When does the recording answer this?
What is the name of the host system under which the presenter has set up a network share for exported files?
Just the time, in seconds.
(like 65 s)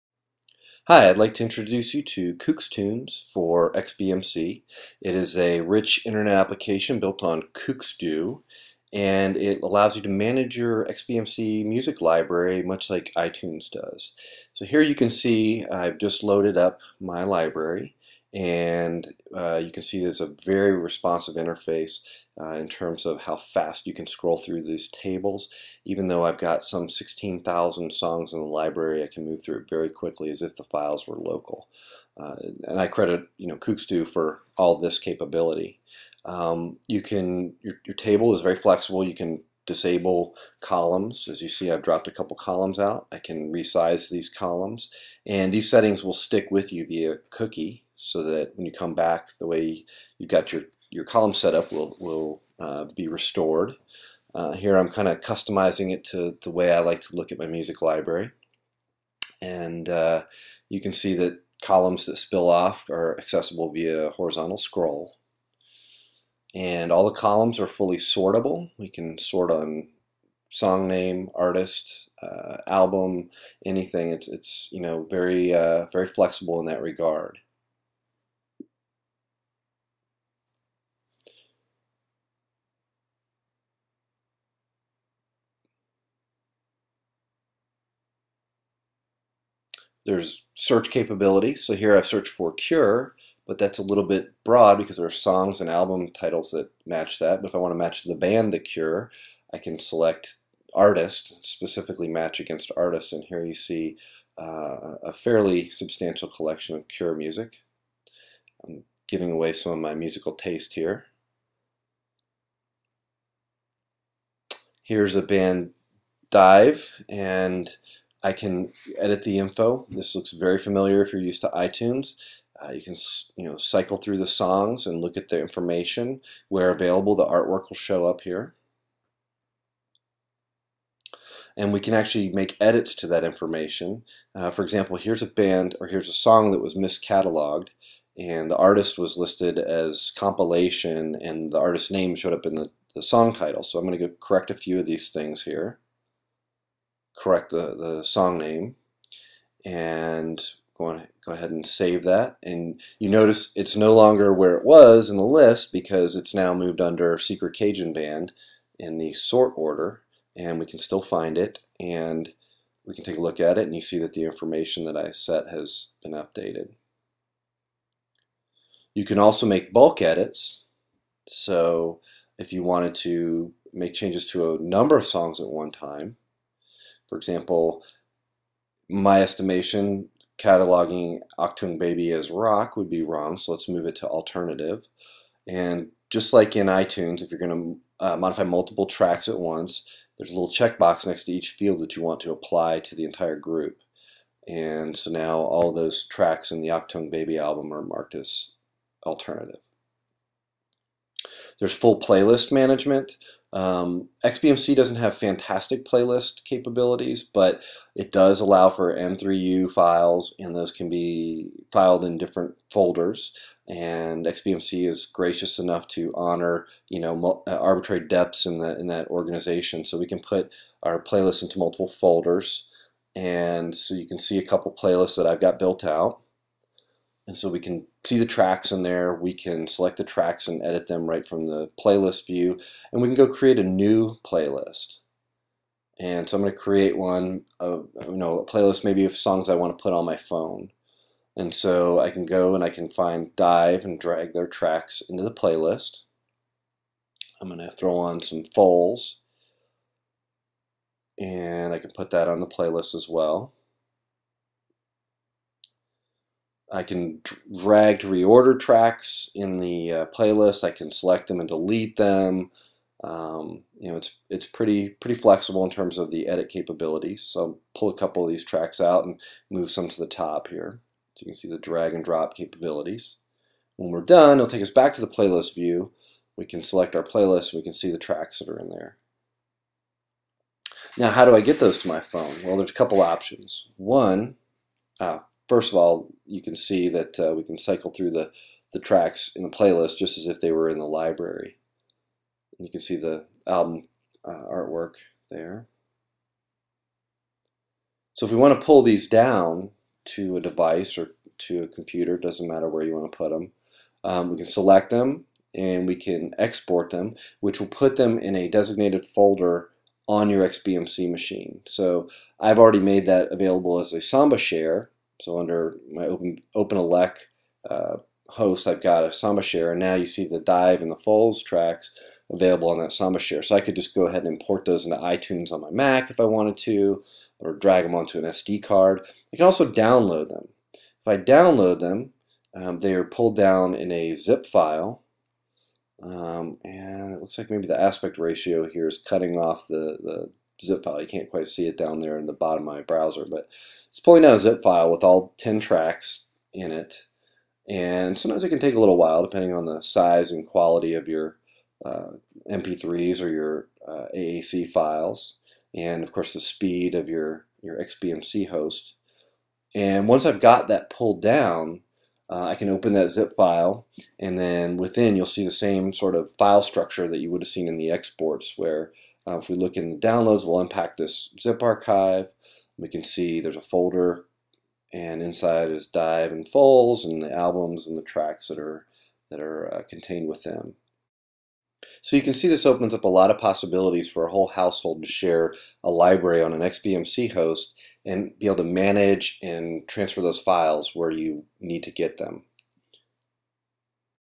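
316 s.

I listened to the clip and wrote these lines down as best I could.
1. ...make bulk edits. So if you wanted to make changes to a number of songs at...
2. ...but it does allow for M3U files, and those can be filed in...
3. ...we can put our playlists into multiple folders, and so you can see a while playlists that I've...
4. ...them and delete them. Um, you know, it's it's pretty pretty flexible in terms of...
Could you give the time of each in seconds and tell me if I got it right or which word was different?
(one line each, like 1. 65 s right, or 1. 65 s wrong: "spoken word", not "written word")
1. 169 s right
2. 207 s right
3. 219 s wrong: "couple", not "while"
4. 261 s right.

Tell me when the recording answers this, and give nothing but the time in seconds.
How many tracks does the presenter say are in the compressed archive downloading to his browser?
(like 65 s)
345 s.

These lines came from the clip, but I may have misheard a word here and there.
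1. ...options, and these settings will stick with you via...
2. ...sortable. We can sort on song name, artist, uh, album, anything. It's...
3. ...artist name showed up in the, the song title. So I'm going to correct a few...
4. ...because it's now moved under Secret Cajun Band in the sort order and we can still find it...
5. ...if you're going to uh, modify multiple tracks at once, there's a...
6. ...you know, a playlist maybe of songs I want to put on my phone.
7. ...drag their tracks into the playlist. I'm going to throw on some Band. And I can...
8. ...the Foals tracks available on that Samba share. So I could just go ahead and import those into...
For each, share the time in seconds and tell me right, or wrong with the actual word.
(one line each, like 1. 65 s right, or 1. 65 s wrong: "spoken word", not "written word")
1. 44 s wrong: "columns", not "options"
2. 67 s right
3. 141 s right
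4. 155 s right
5. 187 s right
6. 238 s right
7. 243 s wrong: "Foals", not "Band"
8. 320 s right.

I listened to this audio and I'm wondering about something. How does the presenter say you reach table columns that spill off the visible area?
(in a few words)
horizontal scroll.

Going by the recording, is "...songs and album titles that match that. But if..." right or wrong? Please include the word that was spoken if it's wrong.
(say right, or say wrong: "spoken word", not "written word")
right.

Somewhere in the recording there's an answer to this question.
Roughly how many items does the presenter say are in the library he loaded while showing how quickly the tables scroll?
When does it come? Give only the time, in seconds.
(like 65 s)
26 s.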